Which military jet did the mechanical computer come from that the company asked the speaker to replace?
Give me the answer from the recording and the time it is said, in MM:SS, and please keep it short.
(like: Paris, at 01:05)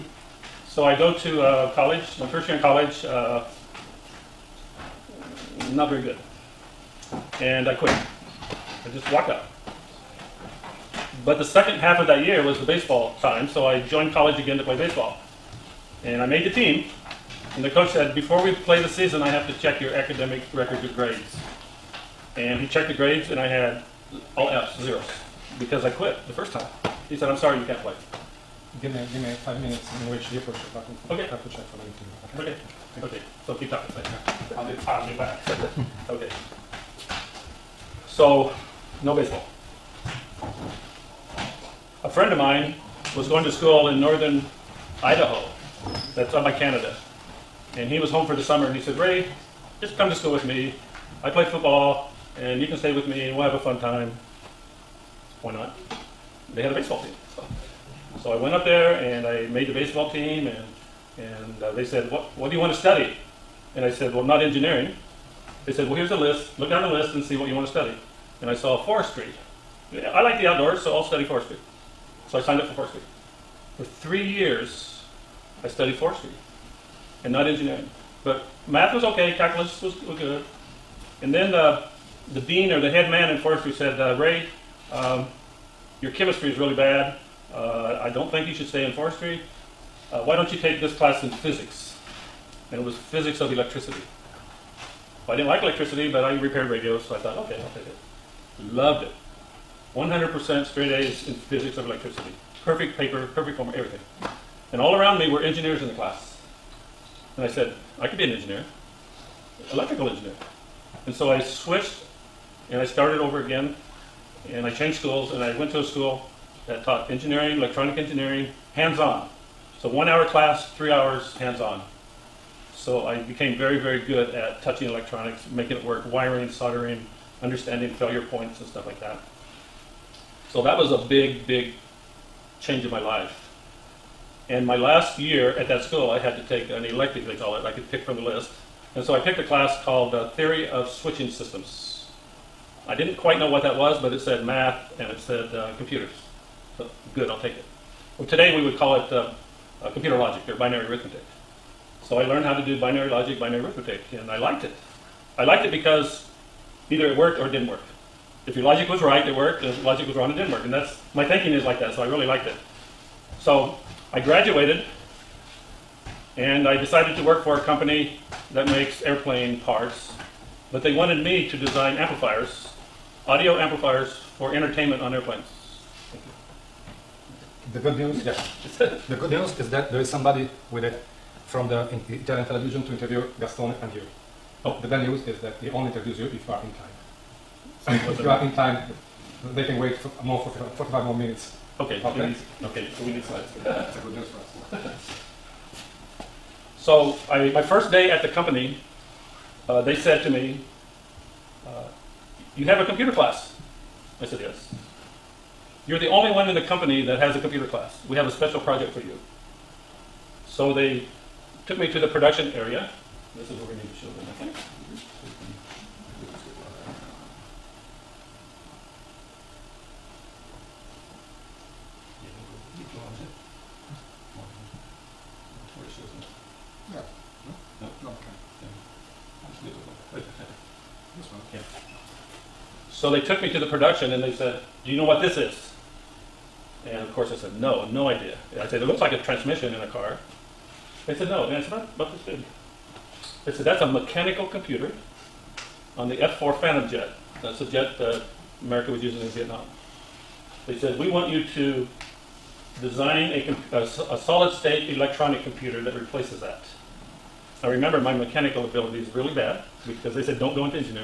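F-4 Phantom, at 04:06.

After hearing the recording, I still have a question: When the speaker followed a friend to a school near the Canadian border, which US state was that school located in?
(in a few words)
Idaho.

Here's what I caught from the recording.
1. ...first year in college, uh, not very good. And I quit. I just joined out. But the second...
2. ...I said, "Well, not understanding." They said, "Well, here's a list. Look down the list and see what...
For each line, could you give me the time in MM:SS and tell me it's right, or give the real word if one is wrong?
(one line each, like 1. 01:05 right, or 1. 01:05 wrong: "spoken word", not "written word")
1. 00:02 wrong: "walked", not "joined"
2. 01:03 wrong: "engineering", not "understanding".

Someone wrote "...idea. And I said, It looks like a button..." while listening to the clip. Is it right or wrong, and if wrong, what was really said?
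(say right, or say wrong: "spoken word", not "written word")
wrong: "transmission", not "button".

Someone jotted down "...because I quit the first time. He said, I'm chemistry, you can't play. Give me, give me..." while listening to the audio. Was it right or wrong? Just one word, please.
wrong.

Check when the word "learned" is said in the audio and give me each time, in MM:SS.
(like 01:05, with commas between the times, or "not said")
02:32.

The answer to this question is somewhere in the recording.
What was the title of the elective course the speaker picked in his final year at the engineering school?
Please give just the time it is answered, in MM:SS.
02:20.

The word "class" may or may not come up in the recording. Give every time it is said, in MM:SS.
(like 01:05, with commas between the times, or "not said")
01:30, 01:45, 02:00, 02:19, 03:23, 03:27.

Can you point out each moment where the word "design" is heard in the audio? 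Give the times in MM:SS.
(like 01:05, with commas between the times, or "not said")
02:51, 04:12.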